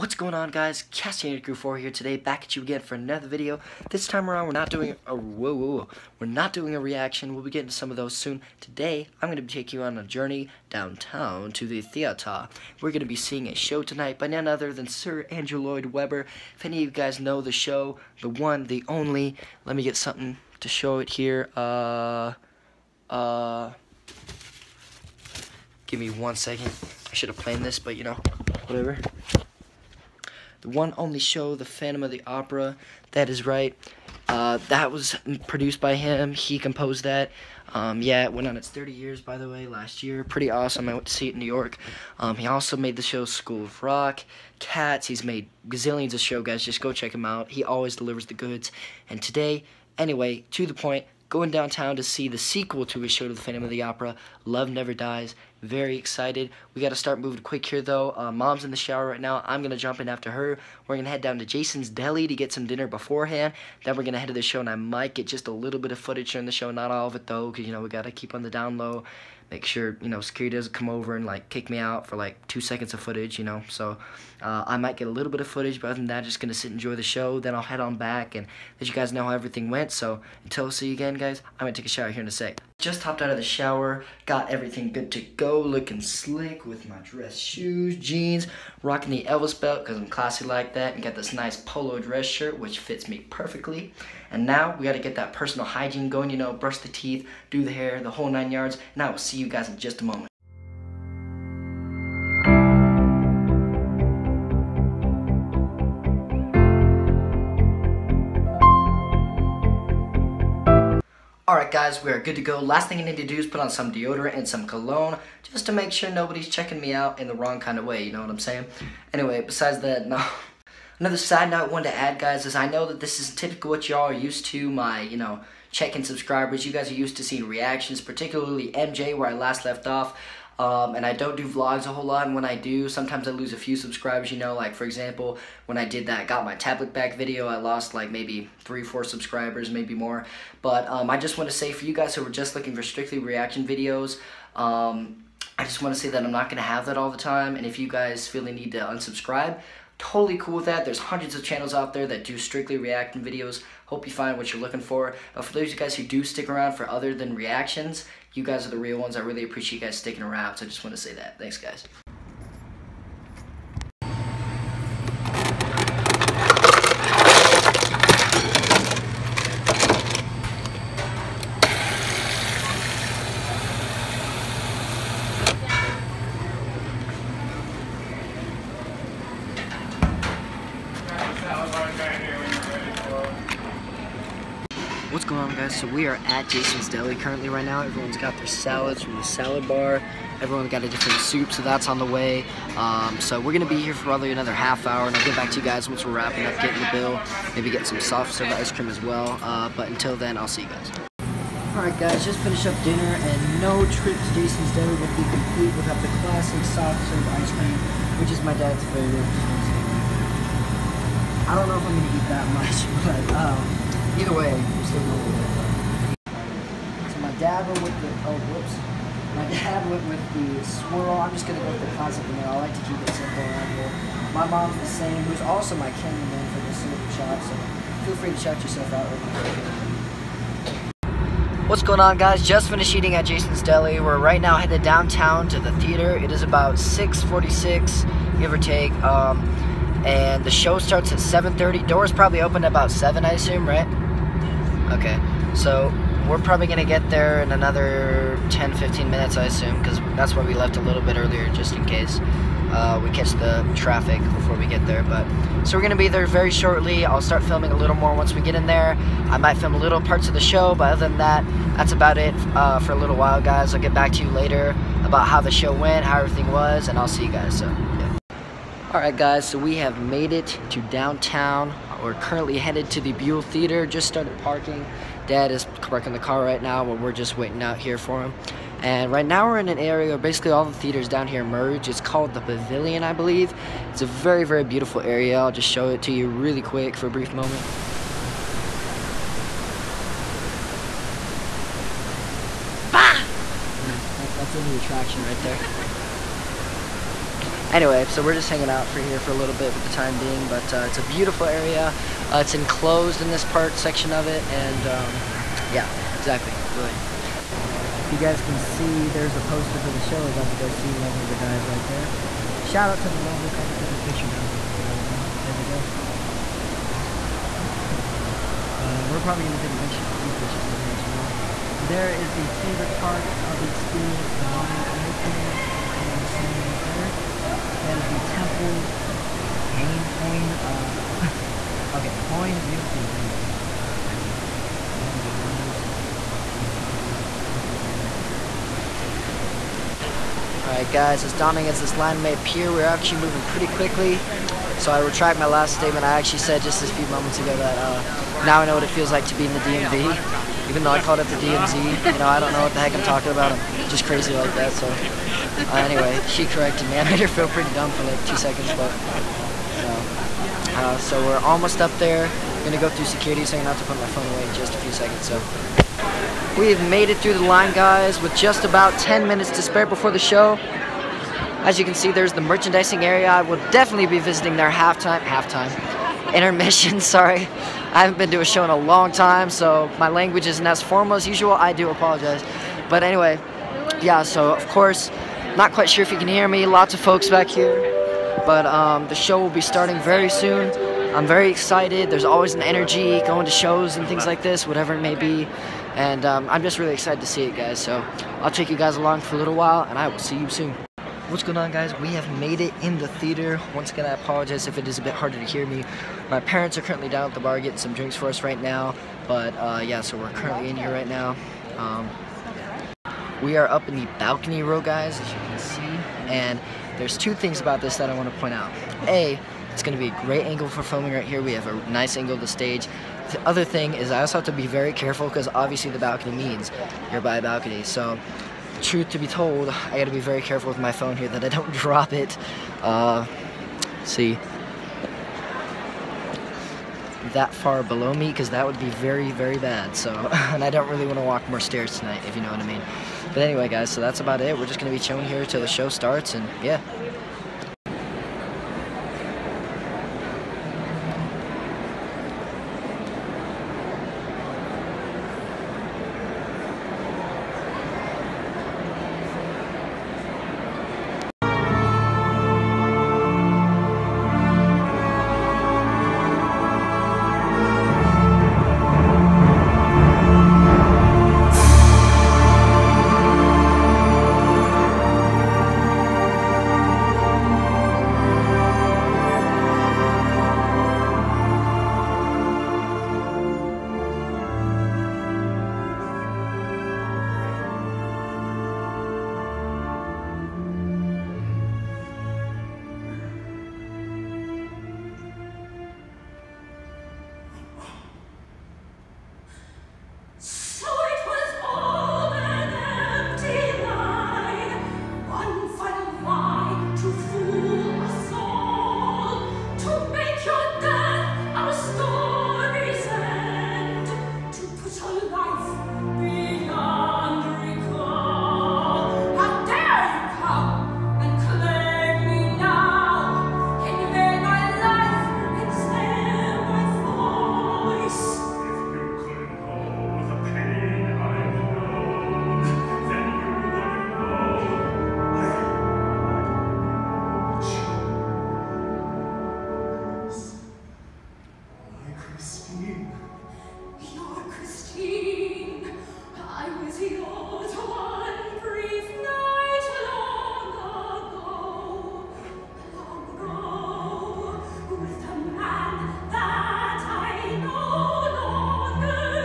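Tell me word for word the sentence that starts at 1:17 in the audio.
Then I'll head on back and let you guys know how everything went.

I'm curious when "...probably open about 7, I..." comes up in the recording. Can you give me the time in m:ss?
4:02.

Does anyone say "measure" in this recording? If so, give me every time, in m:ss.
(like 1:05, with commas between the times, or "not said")
not said.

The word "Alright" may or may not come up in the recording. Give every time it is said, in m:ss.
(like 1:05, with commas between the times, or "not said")
1:51, 3:21, 5:40.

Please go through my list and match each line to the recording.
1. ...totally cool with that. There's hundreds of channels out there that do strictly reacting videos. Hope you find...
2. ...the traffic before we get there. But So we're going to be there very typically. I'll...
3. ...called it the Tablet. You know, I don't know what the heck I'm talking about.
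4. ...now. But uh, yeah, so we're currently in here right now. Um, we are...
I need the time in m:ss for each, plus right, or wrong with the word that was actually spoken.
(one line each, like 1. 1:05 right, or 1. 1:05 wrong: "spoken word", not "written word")
1. 2:29 right
2. 4:13 wrong: "shortly", not "typically"
3. 5:51 wrong: "DMZ", not "Tablet"
4. 6:48 right.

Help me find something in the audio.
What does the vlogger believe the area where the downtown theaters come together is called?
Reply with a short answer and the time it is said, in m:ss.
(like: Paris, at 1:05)
The Pavilion, at 4:42.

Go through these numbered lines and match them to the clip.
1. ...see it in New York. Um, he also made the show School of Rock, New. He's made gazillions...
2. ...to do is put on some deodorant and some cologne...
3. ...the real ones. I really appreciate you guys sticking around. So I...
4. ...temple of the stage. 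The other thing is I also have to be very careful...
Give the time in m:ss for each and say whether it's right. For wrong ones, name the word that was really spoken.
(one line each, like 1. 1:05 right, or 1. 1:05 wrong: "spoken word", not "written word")
1. 0:41 wrong: "Cats", not "New"
2. 1:53 right
3. 2:38 right
4. 7:02 wrong: "angle", not "temple".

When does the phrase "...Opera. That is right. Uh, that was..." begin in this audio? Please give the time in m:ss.
0:32.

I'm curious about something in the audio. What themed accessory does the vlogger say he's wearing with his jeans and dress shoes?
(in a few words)
Elvis belt.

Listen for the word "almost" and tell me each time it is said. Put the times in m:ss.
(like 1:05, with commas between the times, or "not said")
6:01.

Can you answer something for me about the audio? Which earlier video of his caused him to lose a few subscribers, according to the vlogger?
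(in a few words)
Got My Tablet Back.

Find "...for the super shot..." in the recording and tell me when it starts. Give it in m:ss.
3:46.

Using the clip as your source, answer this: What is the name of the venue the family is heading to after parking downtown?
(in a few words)
Buell Theater.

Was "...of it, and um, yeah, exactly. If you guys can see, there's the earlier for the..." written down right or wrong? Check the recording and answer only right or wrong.
wrong.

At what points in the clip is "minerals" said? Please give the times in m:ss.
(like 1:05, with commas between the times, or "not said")
not said.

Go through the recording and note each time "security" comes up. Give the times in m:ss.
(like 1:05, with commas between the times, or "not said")
1:10, 6:03.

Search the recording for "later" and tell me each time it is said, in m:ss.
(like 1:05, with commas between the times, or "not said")
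4:24, 5:20.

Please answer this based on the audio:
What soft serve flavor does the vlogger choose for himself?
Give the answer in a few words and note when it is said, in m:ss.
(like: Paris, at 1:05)
Vanilla, at 3:42.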